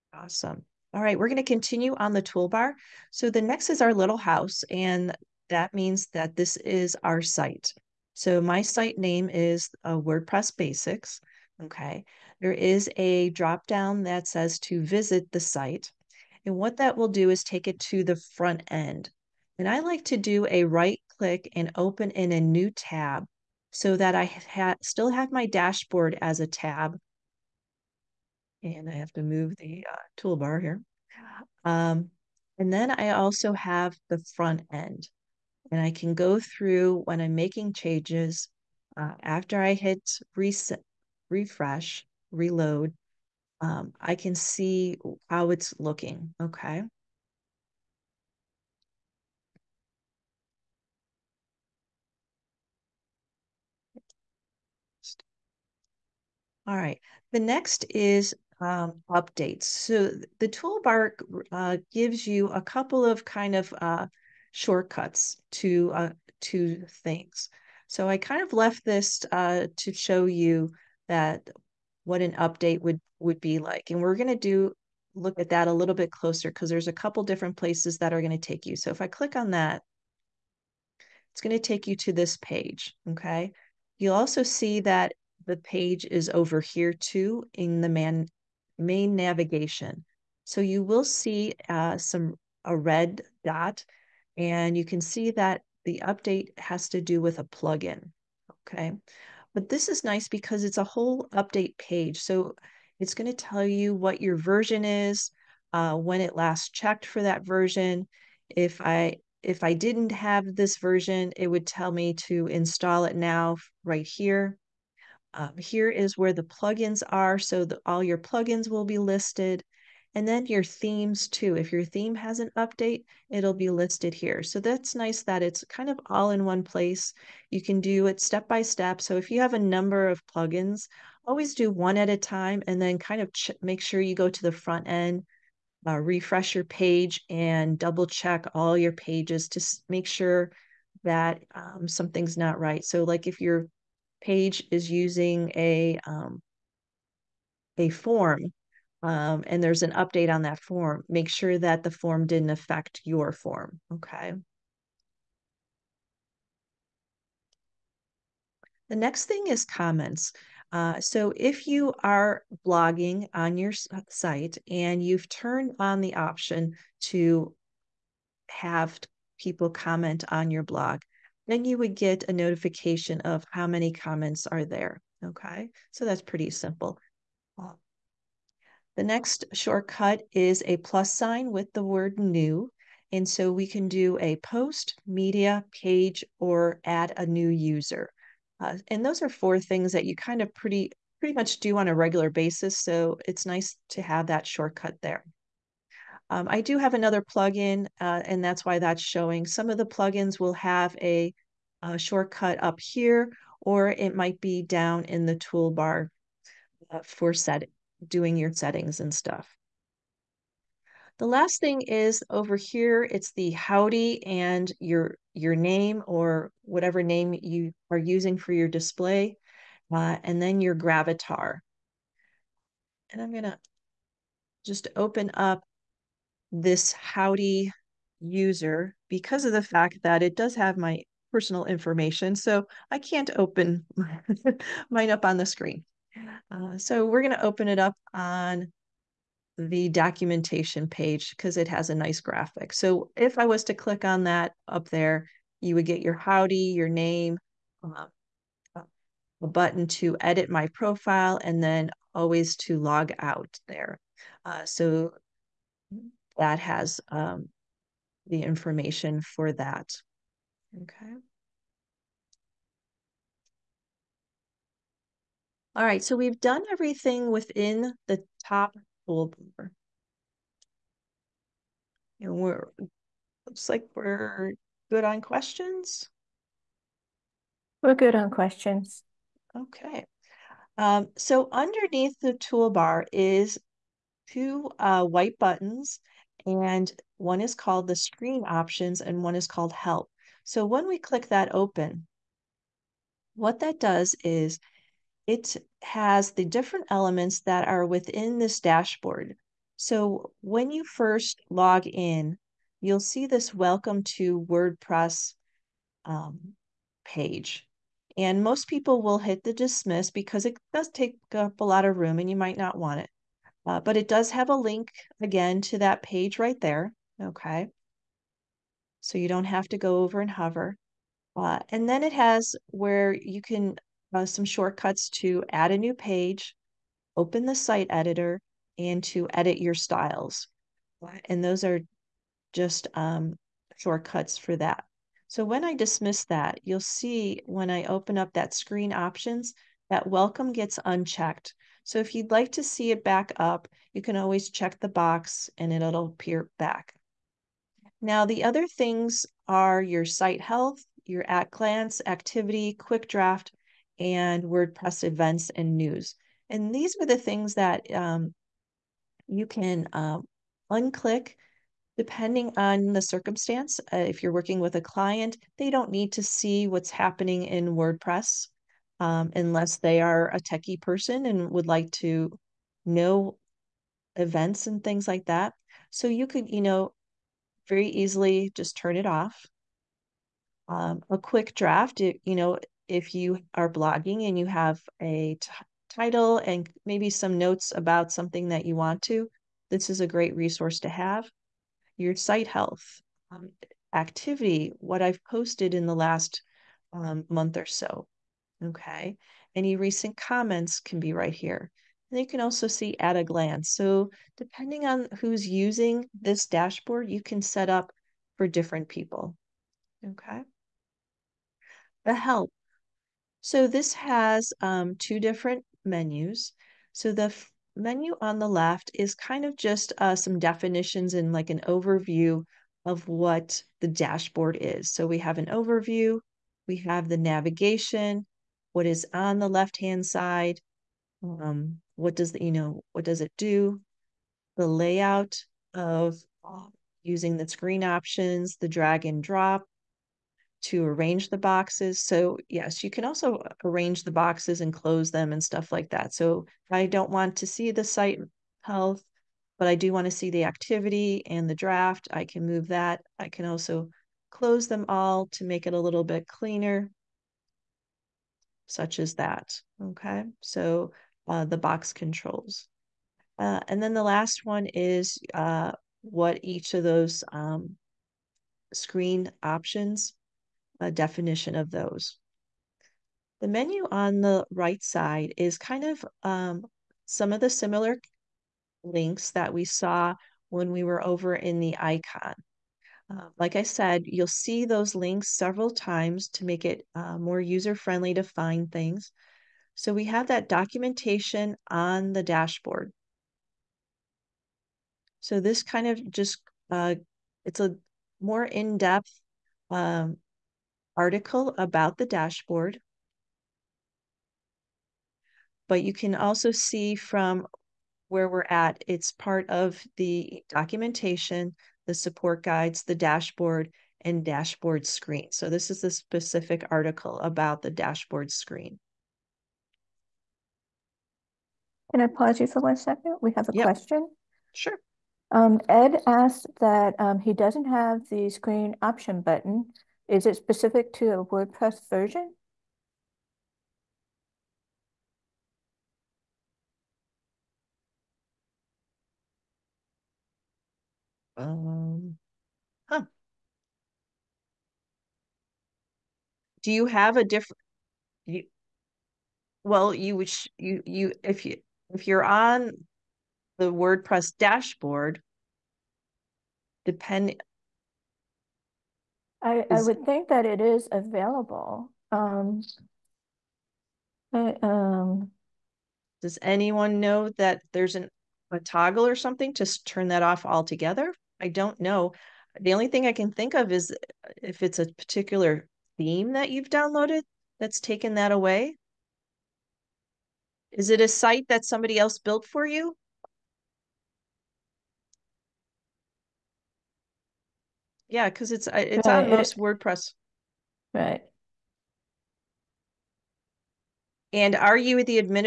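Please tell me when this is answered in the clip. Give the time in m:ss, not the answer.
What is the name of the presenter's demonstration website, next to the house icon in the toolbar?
0:09.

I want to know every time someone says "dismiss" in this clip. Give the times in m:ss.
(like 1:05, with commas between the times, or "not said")
5:09, 5:35.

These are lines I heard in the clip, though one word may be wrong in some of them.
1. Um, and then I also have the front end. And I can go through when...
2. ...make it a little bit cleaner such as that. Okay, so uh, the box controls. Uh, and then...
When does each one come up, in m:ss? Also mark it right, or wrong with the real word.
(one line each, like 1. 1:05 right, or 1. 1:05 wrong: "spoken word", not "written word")
1. 0:31 right
2. 7:35 right.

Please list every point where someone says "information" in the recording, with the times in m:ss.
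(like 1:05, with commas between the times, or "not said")
3:51, 4:18.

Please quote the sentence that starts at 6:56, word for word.
So the menu on the left is kind of just uh, some definitions and like an overview of what the dashboard is.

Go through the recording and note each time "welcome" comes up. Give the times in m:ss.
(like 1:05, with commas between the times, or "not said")
5:03, 5:40.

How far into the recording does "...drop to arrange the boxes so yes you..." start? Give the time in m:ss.
7:19.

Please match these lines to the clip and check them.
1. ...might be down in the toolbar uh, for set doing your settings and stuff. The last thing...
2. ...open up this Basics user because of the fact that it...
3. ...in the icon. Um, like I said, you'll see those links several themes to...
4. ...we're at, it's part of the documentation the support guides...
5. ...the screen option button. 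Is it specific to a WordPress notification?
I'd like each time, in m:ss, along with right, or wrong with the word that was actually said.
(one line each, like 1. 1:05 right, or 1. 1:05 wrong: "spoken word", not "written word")
1. 3:24 right
2. 3:44 wrong: "Howdy", not "Basics"
3. 8:01 wrong: "times", not "themes"
4. 8:28 right
5. 8:48 wrong: "version", not "notification".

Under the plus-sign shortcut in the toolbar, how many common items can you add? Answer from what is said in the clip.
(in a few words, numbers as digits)
4.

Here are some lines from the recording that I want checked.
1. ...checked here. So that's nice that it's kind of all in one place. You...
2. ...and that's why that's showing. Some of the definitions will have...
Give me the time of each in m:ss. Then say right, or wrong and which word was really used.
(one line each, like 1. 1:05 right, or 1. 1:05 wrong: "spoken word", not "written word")
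1. 2:03 wrong: "listed", not "checked"
2. 3:18 wrong: "plugins", not "definitions".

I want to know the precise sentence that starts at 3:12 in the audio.
So it's nice to have that shortcut there.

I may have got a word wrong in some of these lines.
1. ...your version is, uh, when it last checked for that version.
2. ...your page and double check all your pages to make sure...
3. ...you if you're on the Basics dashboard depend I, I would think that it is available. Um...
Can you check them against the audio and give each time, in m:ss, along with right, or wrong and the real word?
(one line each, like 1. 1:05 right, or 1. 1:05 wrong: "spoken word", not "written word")
1. 1:44 right
2. 2:16 right
3. 9:11 wrong: "WordPress", not "Basics".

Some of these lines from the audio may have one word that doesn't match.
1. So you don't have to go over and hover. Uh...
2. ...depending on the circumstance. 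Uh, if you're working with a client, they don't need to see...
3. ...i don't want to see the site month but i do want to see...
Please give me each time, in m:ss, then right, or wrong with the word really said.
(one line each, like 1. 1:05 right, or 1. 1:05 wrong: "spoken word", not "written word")
1. 5:19 right
2. 6:01 right
3. 7:26 wrong: "health", not "month".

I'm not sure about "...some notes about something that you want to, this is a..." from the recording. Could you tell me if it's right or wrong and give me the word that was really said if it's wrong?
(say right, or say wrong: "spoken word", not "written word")
right.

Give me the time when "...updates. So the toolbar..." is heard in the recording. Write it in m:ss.
0:59.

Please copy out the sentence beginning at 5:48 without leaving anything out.
Now, the other things are your site health, your at glance activity, quick draft, and WordPress events and news.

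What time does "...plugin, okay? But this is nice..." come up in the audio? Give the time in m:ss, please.
1:37.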